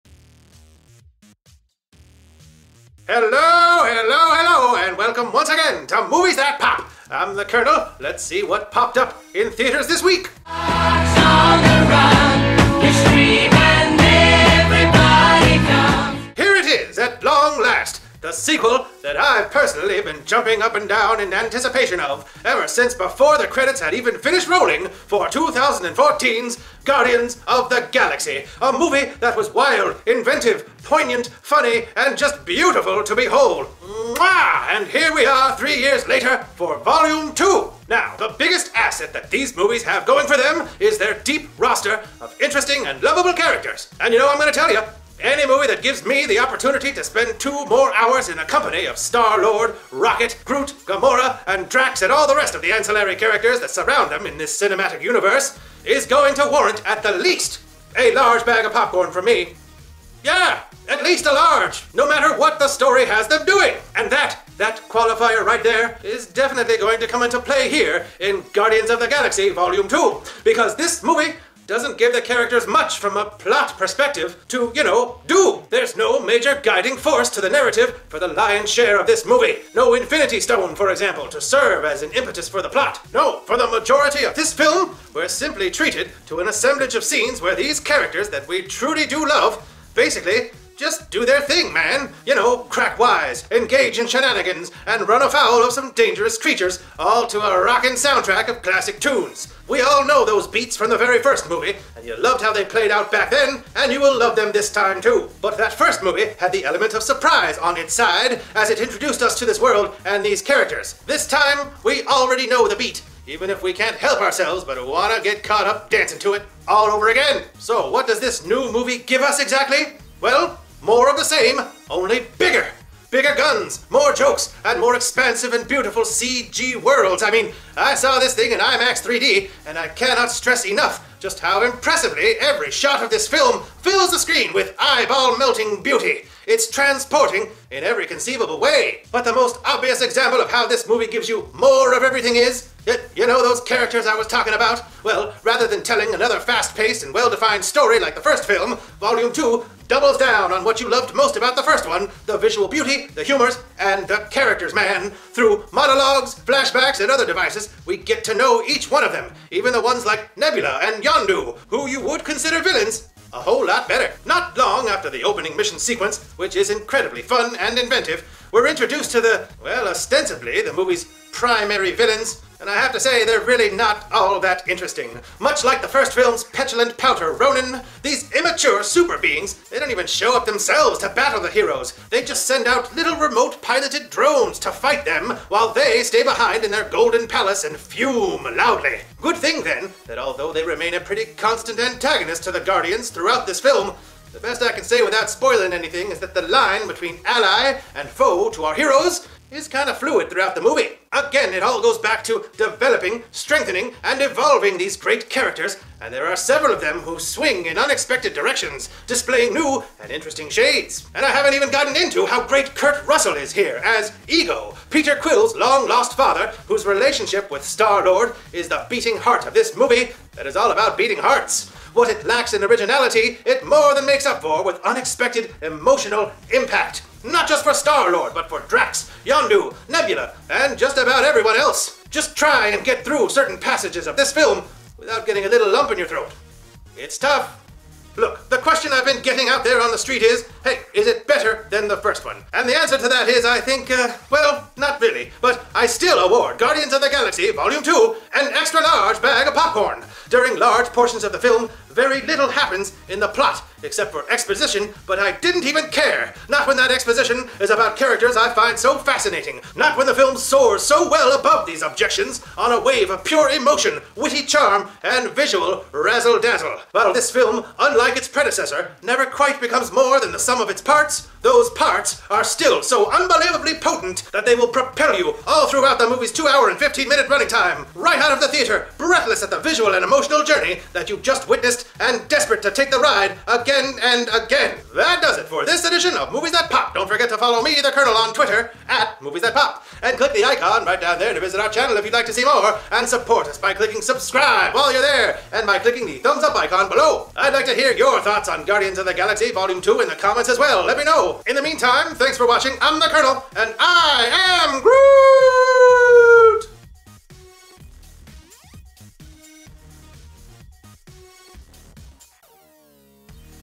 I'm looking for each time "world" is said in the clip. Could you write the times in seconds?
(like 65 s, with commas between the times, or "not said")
109 s, 126 s.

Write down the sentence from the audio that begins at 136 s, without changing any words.
It's transporting in every conceivable way.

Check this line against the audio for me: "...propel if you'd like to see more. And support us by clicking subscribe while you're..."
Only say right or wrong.
wrong.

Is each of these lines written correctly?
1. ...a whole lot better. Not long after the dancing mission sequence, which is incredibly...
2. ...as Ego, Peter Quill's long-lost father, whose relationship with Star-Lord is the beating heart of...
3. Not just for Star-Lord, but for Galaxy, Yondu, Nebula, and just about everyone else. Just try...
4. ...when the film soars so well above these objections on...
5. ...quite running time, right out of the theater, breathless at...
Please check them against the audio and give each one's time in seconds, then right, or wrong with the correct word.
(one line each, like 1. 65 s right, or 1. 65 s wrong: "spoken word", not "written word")
1. 163 s wrong: "opening", not "dancing"
2. 213 s right
3. 227 s wrong: "Drax", not "Galaxy"
4. 259 s right
5. 277 s wrong: "minute", not "quite".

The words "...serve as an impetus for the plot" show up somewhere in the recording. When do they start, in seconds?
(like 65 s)
81 s.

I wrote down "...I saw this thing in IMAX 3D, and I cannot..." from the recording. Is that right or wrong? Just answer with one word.
right.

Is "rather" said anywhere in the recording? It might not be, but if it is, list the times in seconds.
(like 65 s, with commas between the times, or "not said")
145 s.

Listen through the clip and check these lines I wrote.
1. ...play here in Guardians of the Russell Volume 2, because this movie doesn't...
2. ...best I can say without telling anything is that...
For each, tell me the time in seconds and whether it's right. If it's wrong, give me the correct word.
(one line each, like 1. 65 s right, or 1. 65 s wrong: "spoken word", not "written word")
1. 67 s wrong: "Galaxy", not "Russell"
2. 194 s wrong: "spoiling", not "telling".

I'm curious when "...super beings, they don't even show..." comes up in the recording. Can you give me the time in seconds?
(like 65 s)
178 s.